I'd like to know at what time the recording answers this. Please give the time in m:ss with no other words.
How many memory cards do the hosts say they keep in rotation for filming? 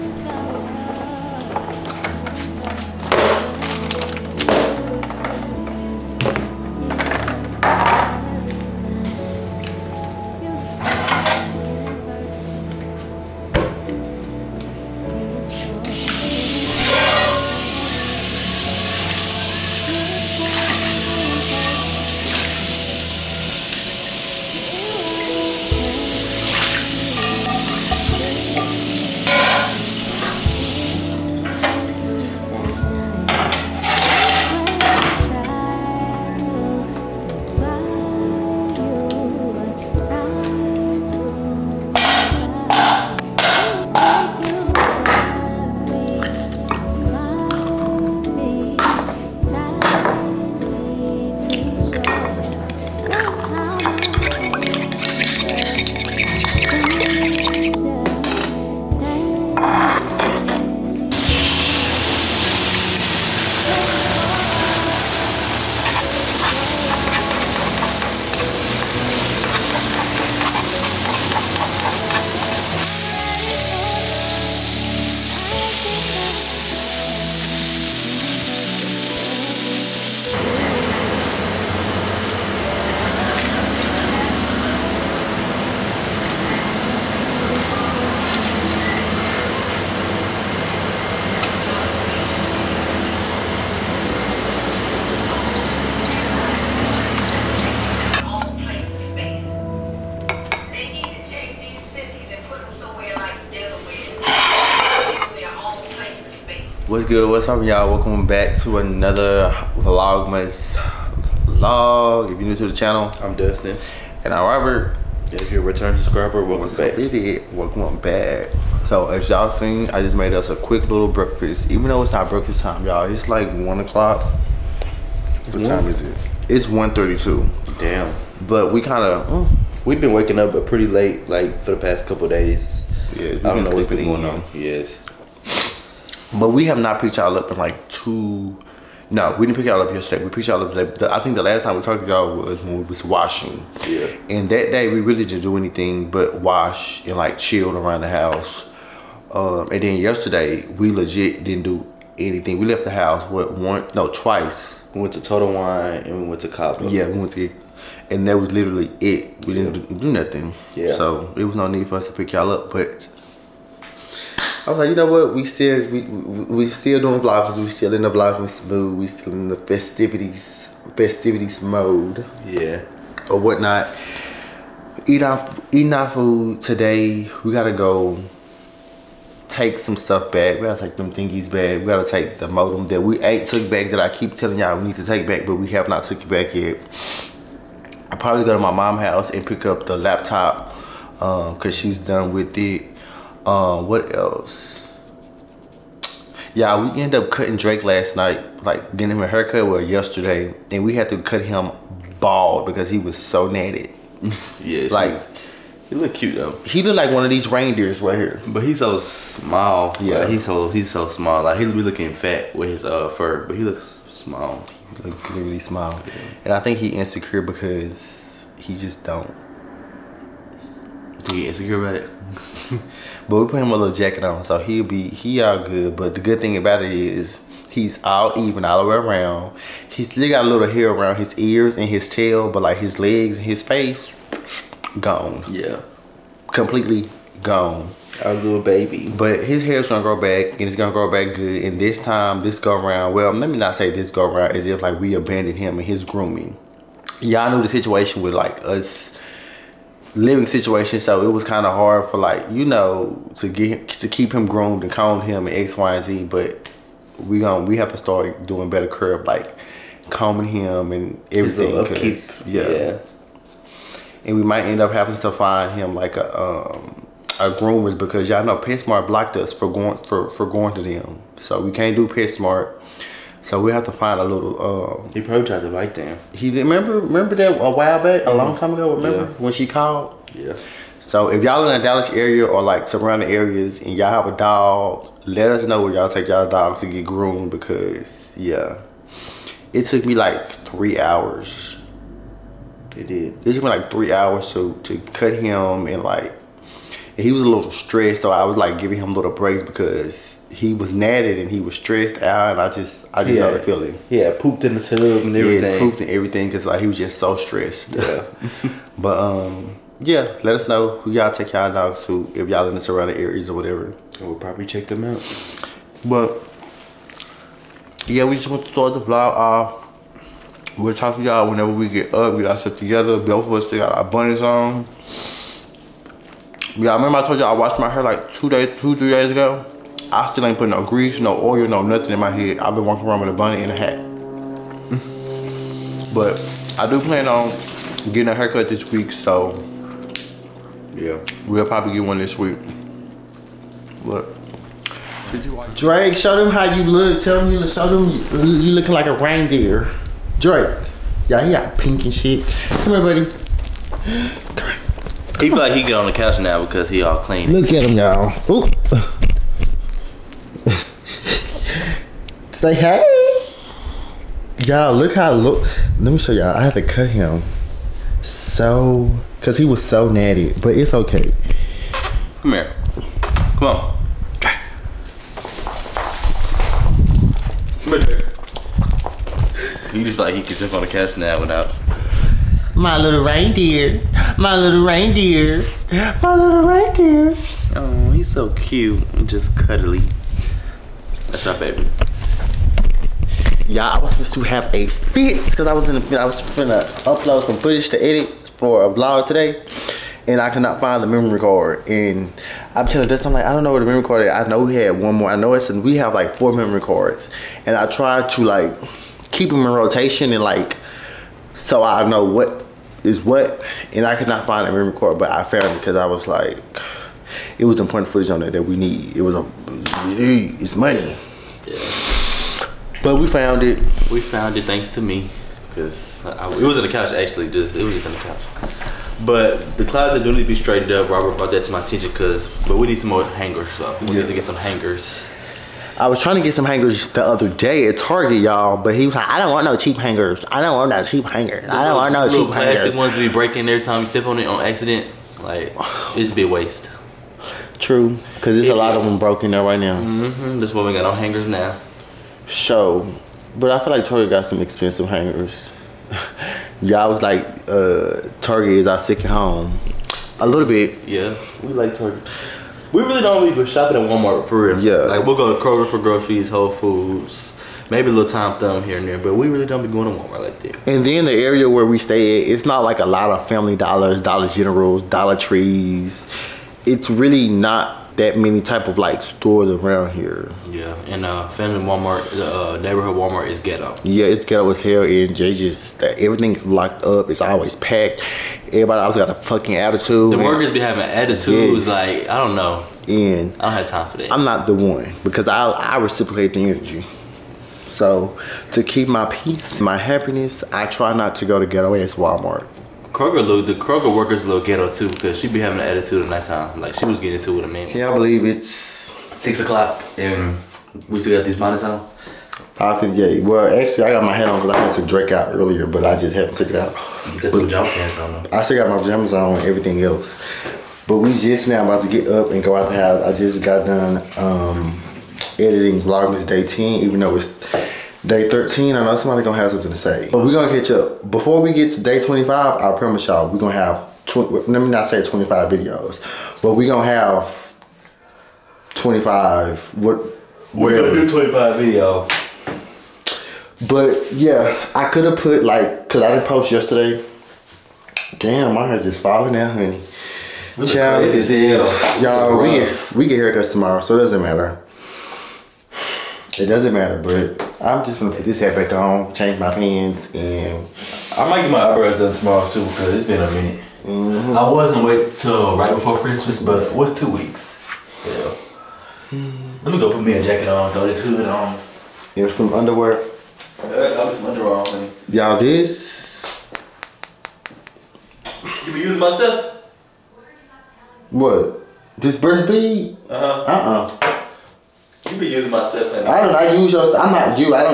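6:46.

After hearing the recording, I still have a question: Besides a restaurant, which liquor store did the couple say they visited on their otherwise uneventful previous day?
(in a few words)
Total Wine.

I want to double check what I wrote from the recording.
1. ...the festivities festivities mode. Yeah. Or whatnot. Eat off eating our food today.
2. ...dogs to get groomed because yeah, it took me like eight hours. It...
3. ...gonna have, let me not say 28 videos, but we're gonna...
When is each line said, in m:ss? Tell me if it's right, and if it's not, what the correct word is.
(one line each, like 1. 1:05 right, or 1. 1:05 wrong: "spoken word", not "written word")
1. 2:49 right
2. 4:46 wrong: "three", not "eight"
3. 8:53 wrong: "25", not "28".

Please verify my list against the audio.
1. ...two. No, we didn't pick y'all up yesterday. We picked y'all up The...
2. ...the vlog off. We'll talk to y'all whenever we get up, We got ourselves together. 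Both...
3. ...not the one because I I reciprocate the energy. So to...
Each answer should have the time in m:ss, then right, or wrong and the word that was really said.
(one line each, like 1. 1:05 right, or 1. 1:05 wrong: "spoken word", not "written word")
1. 2:17 right
2. 5:18 right
3. 8:14 right.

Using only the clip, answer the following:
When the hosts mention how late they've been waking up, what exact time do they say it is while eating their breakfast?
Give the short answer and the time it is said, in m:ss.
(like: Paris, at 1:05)
1:32, at 2:06.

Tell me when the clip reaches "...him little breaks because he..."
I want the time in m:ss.
4:58.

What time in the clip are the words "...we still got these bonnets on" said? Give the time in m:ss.
8:31.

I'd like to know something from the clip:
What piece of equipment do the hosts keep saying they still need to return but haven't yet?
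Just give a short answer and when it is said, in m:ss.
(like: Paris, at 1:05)
modem, at 3:02.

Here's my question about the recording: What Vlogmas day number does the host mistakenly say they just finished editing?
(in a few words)
Day 10.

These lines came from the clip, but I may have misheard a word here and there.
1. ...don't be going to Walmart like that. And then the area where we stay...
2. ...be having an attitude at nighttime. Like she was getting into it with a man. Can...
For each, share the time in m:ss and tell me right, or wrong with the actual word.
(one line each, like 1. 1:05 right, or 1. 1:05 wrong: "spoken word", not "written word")
1. 7:49 right
2. 8:25 right.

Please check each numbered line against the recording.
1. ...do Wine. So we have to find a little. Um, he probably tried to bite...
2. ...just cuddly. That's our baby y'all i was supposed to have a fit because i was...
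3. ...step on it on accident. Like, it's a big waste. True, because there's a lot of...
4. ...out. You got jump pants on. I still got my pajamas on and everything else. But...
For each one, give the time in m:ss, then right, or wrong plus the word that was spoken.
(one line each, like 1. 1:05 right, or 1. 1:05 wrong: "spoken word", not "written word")
1. 4:31 wrong: "PetSmart", not "Wine"
2. 6:29 right
3. 7:24 right
4. 8:36 right.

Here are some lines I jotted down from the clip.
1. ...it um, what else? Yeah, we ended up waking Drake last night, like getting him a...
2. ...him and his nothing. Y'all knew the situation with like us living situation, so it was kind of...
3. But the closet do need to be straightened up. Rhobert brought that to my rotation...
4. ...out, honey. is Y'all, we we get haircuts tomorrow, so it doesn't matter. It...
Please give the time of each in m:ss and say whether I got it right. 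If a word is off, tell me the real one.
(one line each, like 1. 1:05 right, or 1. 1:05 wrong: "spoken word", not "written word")
1. 3:12 wrong: "cutting", not "waking"
2. 4:05 wrong: "grooming", not "nothing"
3. 7:09 wrong: "attention", not "rotation"
4. 9:09 right.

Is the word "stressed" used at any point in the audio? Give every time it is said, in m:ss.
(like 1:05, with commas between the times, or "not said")
4:57, 5:01, 5:07.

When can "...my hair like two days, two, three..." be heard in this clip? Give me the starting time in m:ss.
5:27.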